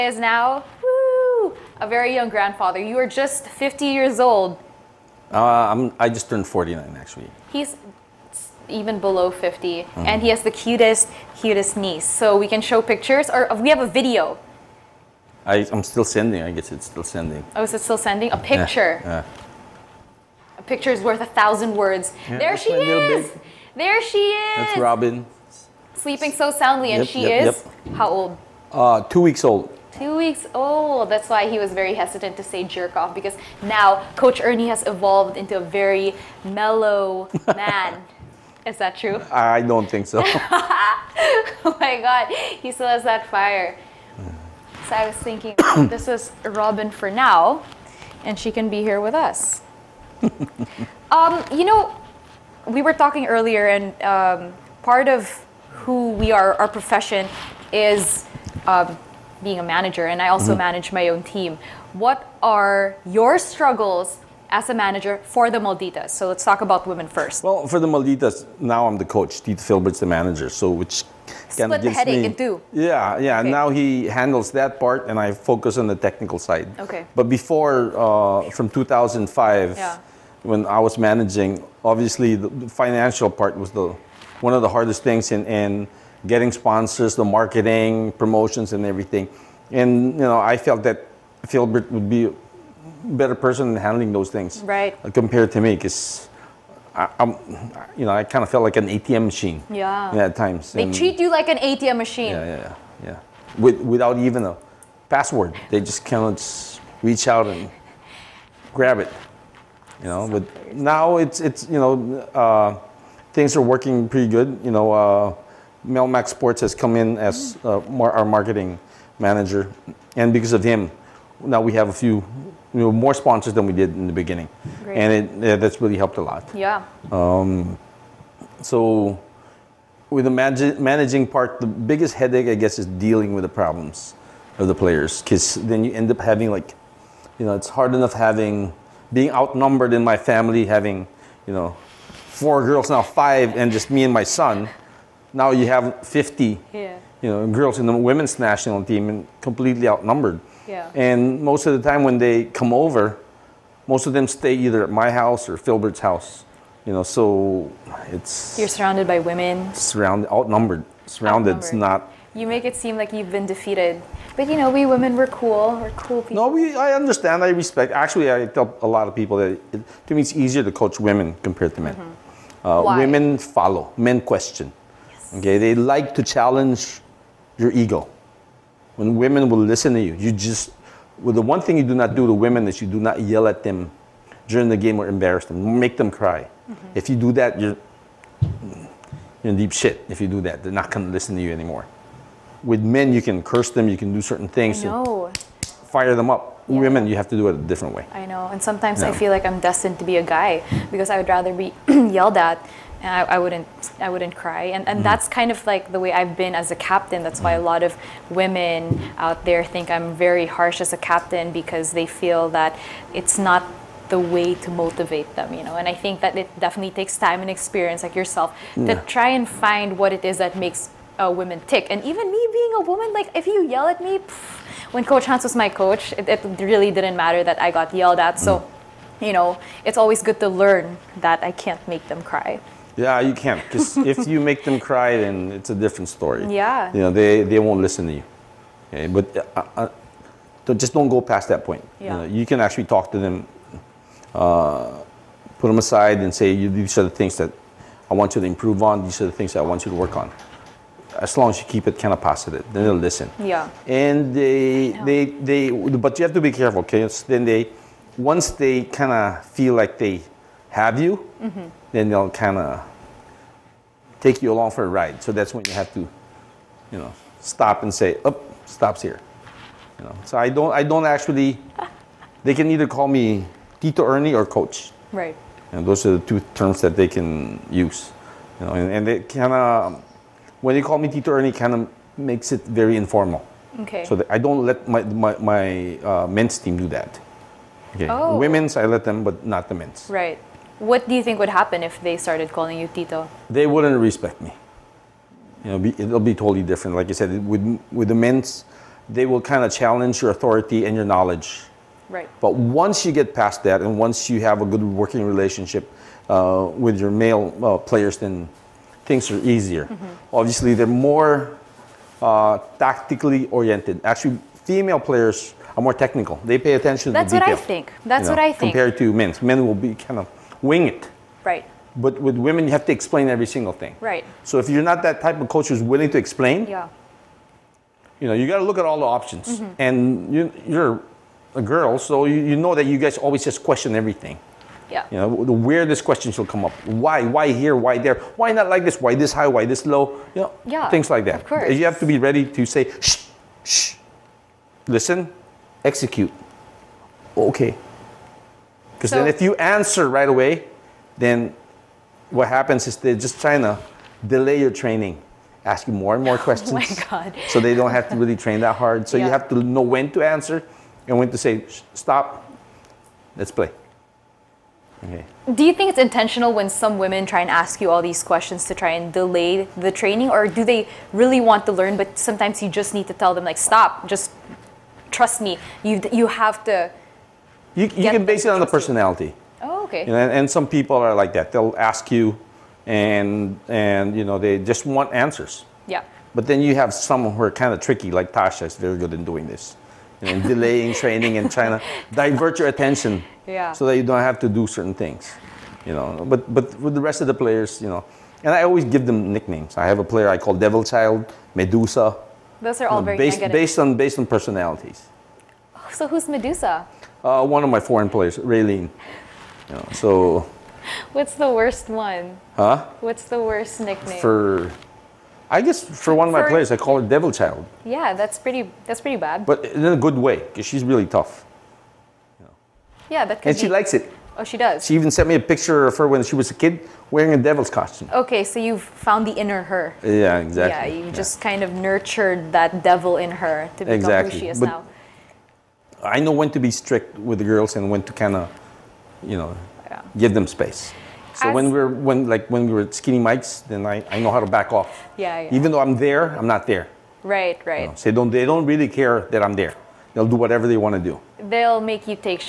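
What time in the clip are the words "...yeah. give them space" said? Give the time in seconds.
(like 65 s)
439 s.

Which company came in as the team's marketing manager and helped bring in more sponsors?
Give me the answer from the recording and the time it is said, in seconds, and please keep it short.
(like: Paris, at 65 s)
Melmac Sports, at 115 s.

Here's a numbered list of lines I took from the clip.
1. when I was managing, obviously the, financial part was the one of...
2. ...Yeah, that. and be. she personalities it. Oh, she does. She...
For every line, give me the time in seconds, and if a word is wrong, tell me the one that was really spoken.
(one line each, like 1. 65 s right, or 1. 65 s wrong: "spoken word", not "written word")
1. 80 s right
2. 423 s wrong: "likes", not "personalities".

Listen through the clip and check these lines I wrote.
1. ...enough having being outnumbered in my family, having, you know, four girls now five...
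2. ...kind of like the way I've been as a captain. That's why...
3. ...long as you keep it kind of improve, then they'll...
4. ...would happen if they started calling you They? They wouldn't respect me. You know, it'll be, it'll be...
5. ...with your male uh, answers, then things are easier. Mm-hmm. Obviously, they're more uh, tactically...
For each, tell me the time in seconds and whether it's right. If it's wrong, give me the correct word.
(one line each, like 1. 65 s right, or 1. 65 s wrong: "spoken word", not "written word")
1. 137 s right
2. 205 s right
3. 251 s wrong: "positive", not "improve"
4. 291 s wrong: "Tito", not "They"
5. 306 s wrong: "players", not "answers".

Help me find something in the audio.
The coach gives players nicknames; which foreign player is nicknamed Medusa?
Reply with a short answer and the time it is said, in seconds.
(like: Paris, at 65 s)
Raylene, at 408 s.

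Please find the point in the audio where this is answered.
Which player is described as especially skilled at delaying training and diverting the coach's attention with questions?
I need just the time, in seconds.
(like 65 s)
388 s.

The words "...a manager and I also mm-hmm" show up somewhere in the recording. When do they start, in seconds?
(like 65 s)
59 s.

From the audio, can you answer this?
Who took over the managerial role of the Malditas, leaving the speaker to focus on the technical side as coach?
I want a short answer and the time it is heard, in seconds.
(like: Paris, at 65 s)
Tito Filbert, at 69 s.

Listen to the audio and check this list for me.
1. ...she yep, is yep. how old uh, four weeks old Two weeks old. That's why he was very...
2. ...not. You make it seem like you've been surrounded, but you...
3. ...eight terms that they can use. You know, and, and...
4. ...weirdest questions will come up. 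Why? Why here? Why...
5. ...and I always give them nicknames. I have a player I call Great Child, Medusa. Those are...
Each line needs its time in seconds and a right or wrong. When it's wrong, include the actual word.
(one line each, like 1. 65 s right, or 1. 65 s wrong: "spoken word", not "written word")
1. 27 s wrong: "two", not "four"
2. 161 s wrong: "defeated", not "surrounded"
3. 276 s wrong: "two", not "eight"
4. 335 s right
5. 398 s wrong: "Devil", not "Great".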